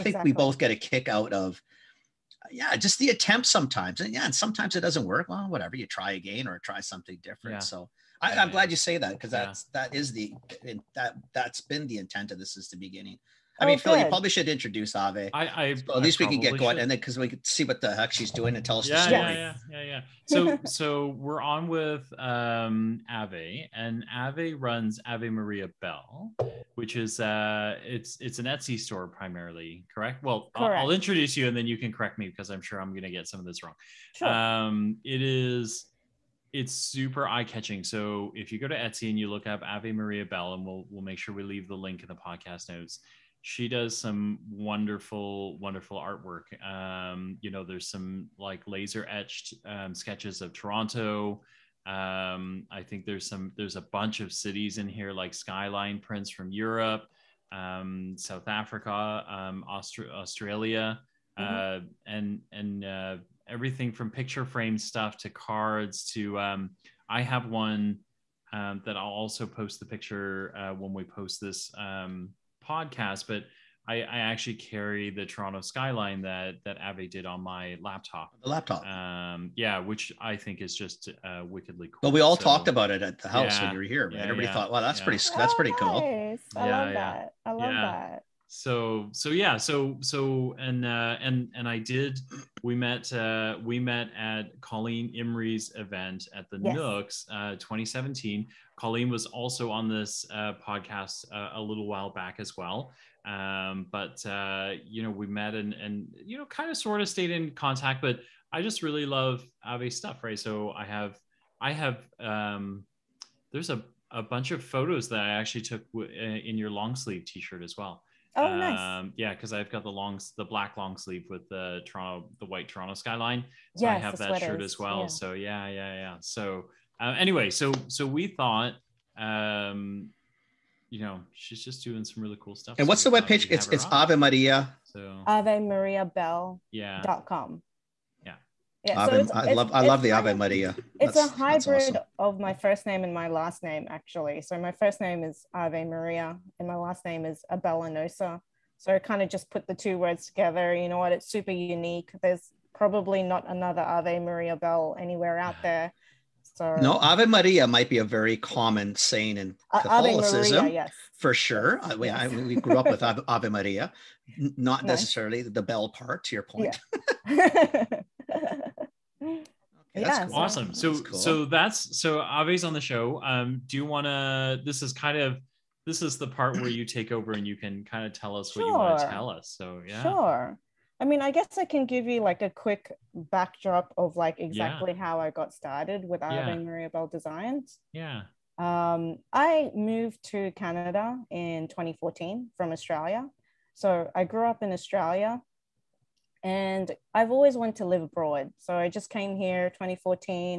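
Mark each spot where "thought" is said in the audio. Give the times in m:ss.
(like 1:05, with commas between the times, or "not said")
1:24, 2:08.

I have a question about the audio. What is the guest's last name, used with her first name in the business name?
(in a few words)
Abellanosa.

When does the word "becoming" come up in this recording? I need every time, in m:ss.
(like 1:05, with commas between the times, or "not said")
not said.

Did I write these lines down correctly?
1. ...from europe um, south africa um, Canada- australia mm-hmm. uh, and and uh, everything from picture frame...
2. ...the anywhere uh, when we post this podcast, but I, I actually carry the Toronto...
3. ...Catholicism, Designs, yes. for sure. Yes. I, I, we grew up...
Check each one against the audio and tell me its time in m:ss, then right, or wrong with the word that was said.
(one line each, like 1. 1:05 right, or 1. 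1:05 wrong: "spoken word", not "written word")
1. 0:56 wrong: "Austra", not "Canada"
2. 1:09 wrong: "picture", not "anywhere"
3. 2:39 wrong: "Maria", not "Designs".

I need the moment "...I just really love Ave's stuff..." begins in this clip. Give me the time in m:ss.
1:48.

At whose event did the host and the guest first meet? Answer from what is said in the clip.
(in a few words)
Colleen Imrie.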